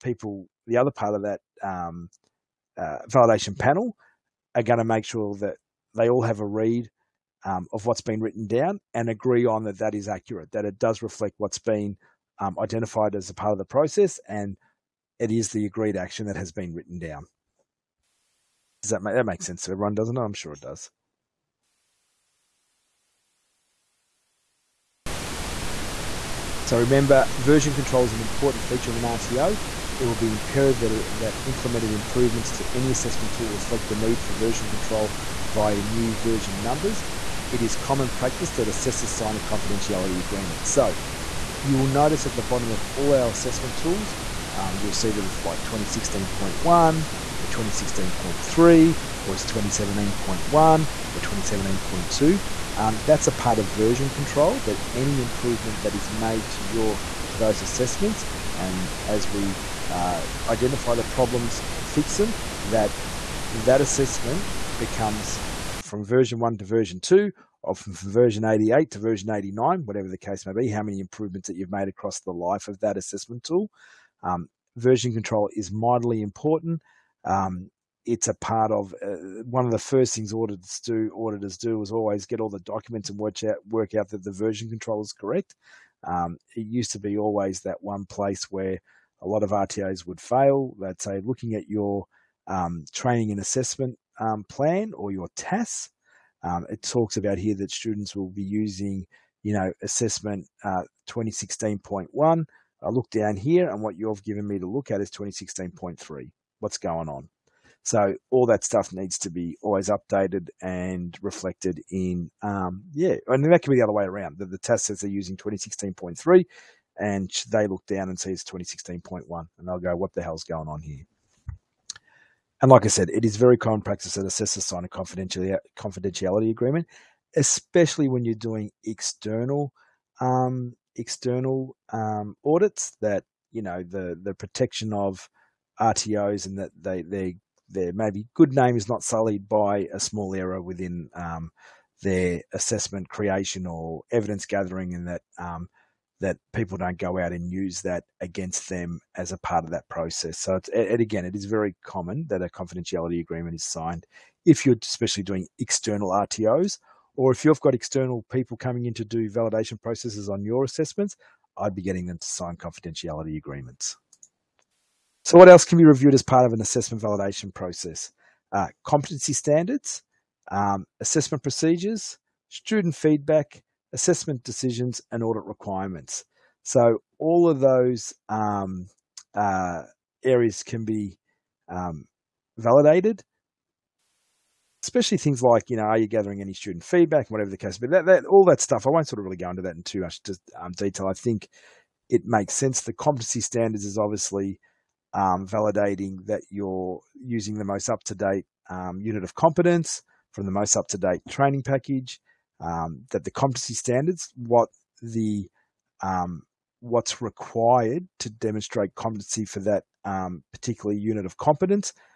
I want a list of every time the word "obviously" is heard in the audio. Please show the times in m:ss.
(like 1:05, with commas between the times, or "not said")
3:13.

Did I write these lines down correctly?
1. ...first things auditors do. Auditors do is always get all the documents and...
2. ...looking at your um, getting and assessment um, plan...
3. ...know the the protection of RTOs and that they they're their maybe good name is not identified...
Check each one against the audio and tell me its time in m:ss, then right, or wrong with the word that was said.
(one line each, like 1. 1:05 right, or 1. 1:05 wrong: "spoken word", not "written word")
1. 1:19 right
2. 1:31 wrong: "training", not "getting"
3. 2:13 wrong: "sullied", not "identified".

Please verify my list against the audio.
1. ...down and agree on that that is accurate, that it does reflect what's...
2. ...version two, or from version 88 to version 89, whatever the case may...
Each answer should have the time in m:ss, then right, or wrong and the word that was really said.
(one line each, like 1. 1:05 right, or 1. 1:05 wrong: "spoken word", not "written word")
1. 0:08 right
2. 1:06 right.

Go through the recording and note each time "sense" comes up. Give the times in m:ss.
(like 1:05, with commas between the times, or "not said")
0:19, 3:12.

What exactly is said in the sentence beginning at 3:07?
But that, that all that stuff, I won't sort of really go into that in too much um, detail.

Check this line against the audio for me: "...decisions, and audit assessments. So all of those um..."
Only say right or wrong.
wrong.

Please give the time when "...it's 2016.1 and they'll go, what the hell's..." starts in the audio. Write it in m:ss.
1:58.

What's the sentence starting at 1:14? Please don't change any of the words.
Um, version control is mightily important.